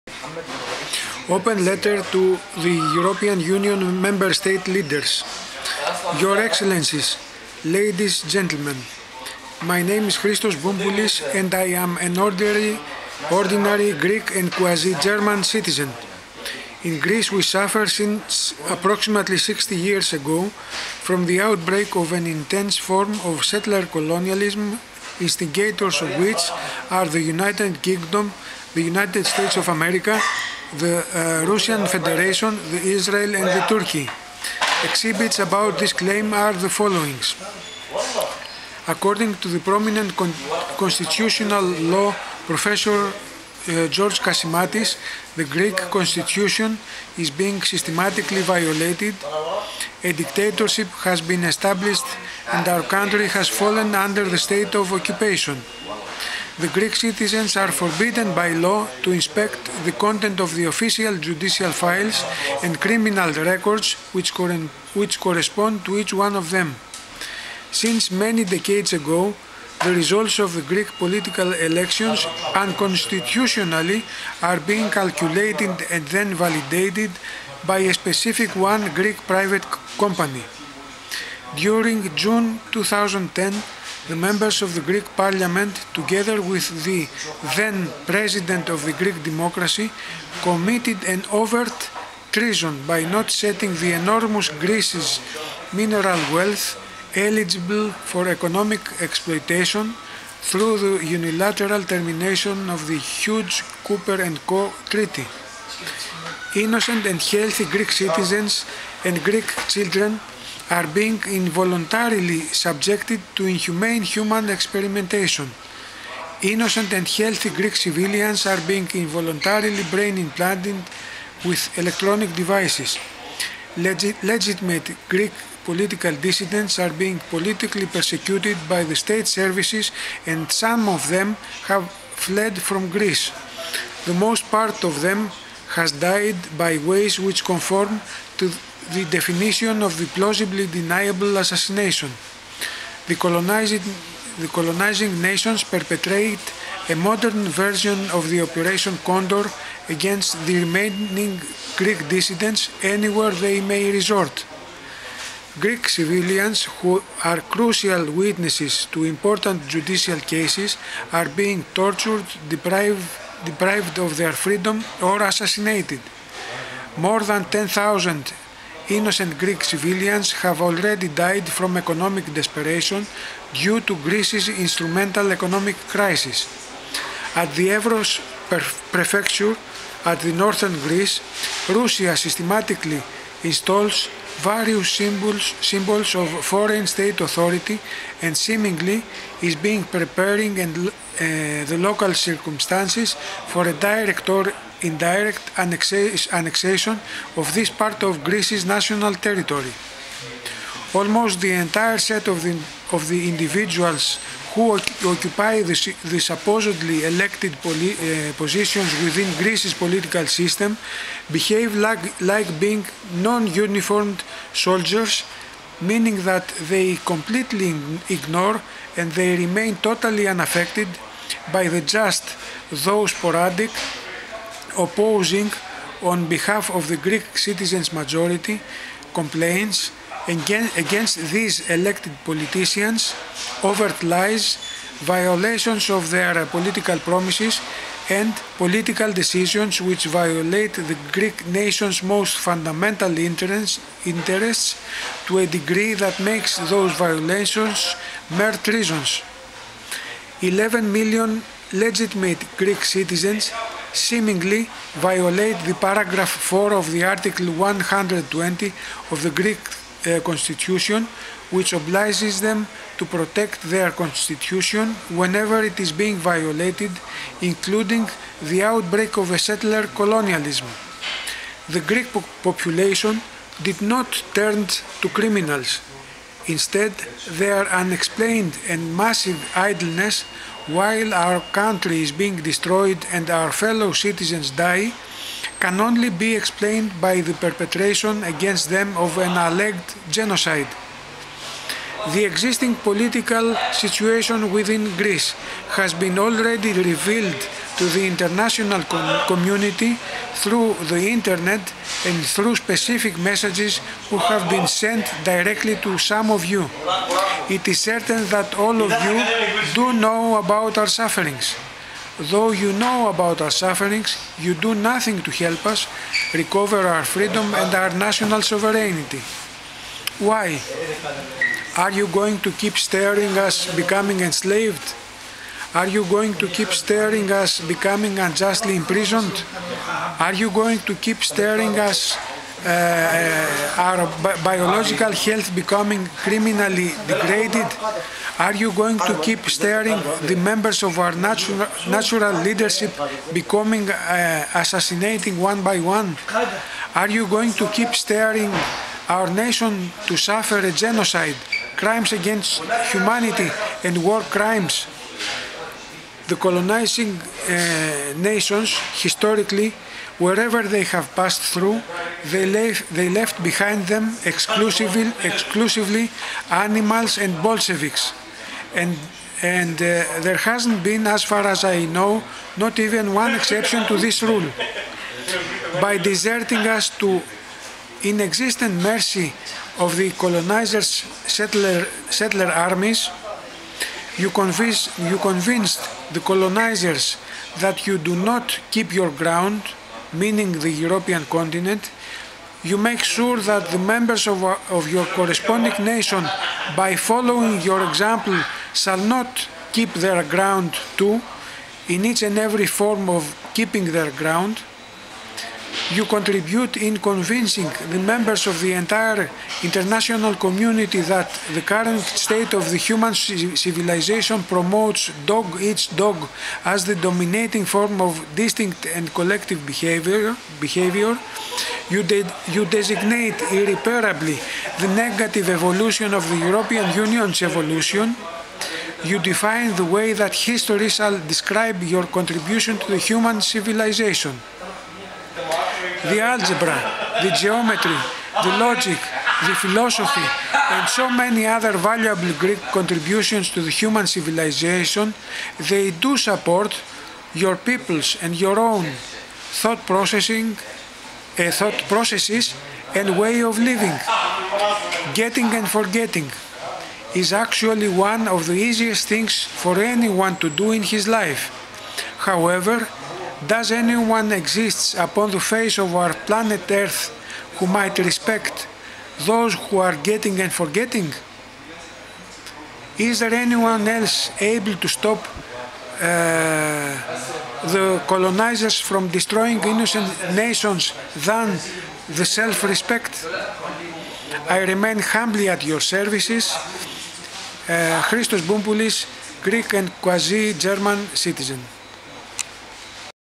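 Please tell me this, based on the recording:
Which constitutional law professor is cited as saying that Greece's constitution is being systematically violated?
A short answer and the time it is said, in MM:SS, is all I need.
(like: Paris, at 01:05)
George Kasimatis, at 00:43.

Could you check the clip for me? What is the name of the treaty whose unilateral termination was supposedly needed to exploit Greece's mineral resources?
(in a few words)
Cooper and Co treaty.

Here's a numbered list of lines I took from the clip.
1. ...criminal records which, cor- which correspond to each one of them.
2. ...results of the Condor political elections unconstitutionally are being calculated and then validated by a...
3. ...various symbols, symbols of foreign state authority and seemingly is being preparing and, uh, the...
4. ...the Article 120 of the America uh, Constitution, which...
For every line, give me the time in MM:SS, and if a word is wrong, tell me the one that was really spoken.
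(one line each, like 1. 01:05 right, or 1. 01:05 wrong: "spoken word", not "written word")
1. 01:02 right
2. 01:09 wrong: "Greek", not "Condor"
3. 03:04 right
4. 04:16 wrong: "Greek", not "America".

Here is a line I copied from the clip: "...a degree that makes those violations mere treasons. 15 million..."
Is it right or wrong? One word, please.
wrong.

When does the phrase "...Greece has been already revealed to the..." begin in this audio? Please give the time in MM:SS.
04:54.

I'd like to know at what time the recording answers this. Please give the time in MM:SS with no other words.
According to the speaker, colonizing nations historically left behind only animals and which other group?
06:07.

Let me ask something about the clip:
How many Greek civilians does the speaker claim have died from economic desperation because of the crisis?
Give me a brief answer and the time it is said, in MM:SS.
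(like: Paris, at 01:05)
More than 10,000, at 02:46.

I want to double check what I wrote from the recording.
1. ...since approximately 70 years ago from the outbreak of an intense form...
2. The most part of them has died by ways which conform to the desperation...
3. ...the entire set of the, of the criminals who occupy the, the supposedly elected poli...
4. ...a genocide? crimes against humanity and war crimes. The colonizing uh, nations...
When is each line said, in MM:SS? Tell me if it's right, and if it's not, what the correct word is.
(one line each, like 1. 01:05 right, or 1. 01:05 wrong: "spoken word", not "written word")
1. 00:17 wrong: "60", not "70"
2. 02:14 wrong: "definition", not "desperation"
3. 03:21 wrong: "individuals", not "criminals"
4. 05:50 right.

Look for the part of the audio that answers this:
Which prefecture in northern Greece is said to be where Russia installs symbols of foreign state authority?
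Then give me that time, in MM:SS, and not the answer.
02:57.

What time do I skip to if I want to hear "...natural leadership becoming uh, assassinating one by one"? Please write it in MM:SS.
05:41.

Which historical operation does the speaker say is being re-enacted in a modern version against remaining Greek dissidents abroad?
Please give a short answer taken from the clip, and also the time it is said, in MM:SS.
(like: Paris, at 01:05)
Operation Condor, at 02:28.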